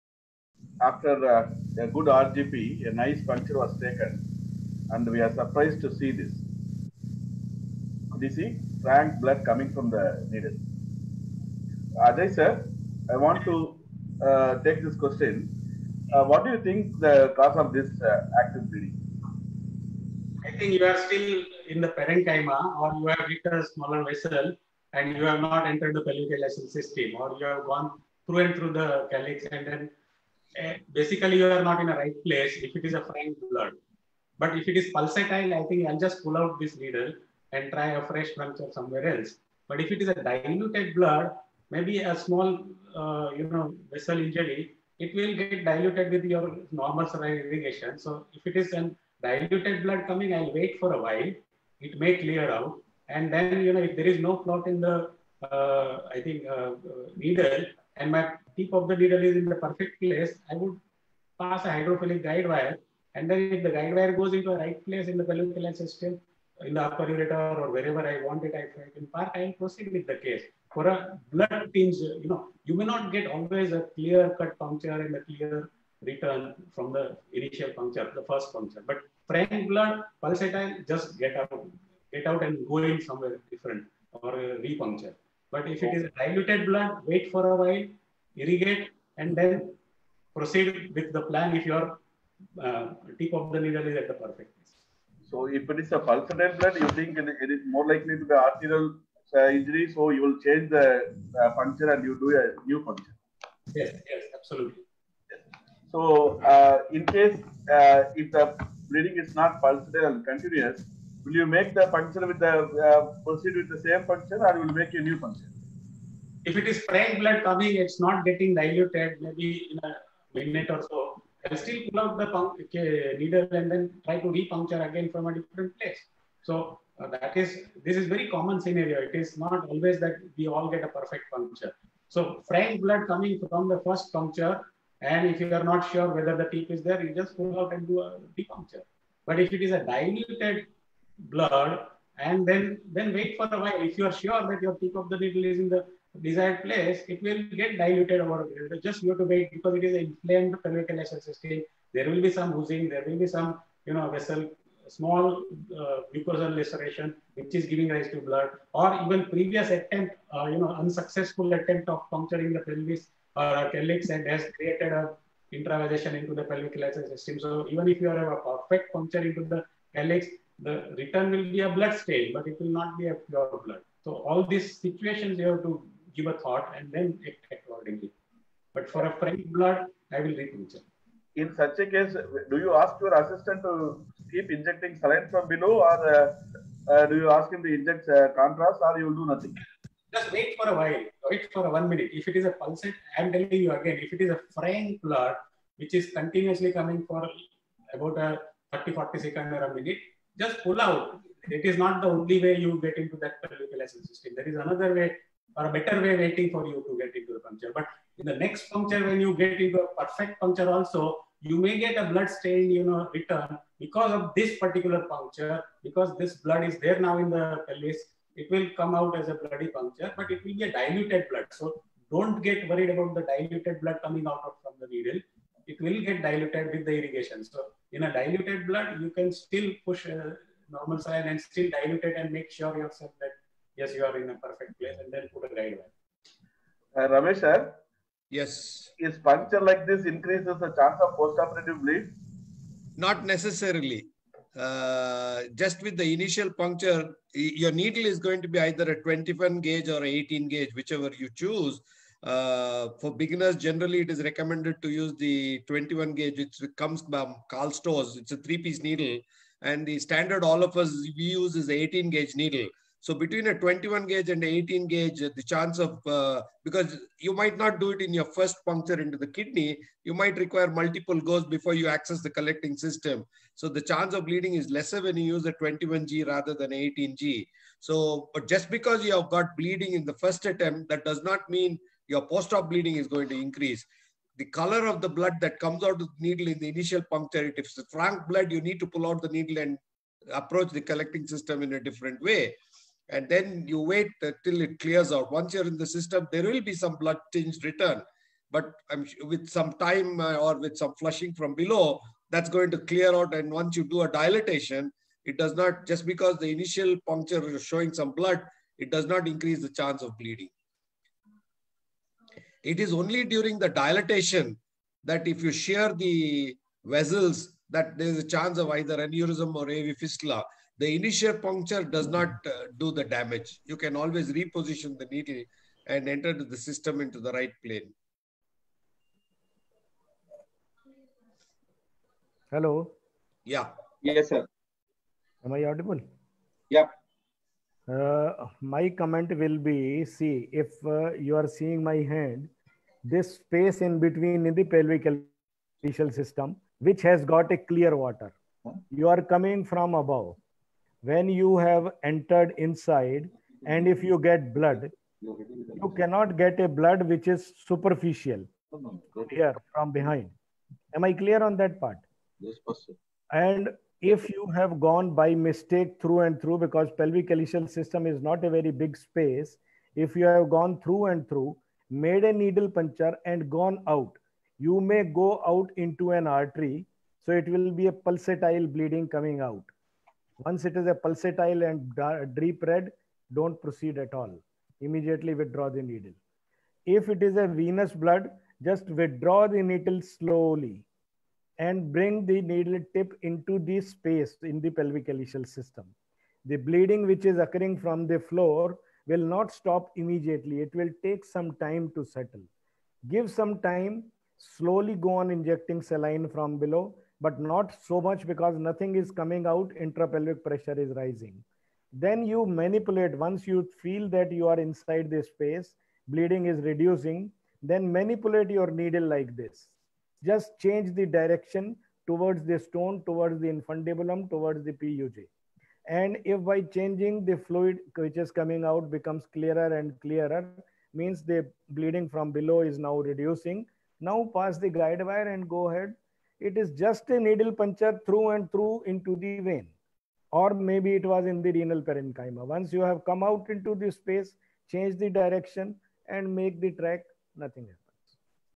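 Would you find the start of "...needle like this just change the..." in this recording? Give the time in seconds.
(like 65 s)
418 s.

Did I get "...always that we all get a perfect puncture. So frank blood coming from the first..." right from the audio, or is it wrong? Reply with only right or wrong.
right.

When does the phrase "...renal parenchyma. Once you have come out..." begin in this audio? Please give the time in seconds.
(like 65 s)
441 s.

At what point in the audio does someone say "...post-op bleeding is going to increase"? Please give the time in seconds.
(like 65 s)
282 s.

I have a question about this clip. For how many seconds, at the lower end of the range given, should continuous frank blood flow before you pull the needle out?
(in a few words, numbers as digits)
30.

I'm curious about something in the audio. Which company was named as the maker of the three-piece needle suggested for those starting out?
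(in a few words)
Karl Storz.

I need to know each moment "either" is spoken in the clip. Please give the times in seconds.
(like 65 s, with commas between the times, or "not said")
248 s, 318 s.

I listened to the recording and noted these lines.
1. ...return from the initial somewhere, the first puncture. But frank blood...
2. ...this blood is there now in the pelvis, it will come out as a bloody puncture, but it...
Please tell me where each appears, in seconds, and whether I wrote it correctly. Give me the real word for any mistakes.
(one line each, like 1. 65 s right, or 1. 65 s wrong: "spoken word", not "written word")
1. 76 s wrong: "puncture", not "somewhere"
2. 216 s right.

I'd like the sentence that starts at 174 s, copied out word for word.
So all these situations you have to give a thought and then act accordingly.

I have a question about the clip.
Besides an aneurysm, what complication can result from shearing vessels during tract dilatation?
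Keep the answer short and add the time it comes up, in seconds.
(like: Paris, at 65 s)
AV fistula, at 319 s.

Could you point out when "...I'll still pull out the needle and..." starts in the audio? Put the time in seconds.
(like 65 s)
121 s.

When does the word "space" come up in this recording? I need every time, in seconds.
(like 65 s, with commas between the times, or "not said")
343 s, 368 s, 393 s, 415 s, 443 s.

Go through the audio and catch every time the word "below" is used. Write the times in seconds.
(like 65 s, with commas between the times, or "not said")
185 s, 301 s, 406 s, 432 s.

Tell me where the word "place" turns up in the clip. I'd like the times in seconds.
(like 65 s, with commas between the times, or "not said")
32 s, 59 s, 64 s, 94 s, 125 s, 146 s, 234 s.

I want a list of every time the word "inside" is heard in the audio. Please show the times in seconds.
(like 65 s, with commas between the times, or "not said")
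352 s, 414 s.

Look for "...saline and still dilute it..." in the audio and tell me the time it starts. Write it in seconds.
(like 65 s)
230 s.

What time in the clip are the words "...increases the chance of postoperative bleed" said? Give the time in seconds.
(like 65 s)
240 s.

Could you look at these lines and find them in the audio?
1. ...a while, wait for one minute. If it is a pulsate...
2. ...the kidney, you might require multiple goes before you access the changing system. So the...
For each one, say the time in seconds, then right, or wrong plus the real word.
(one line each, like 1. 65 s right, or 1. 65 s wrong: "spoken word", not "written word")
1. 190 s right
2. 269 s wrong: "collecting", not "changing".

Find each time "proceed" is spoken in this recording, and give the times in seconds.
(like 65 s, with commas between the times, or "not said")
69 s, 90 s, 113 s, 383 s.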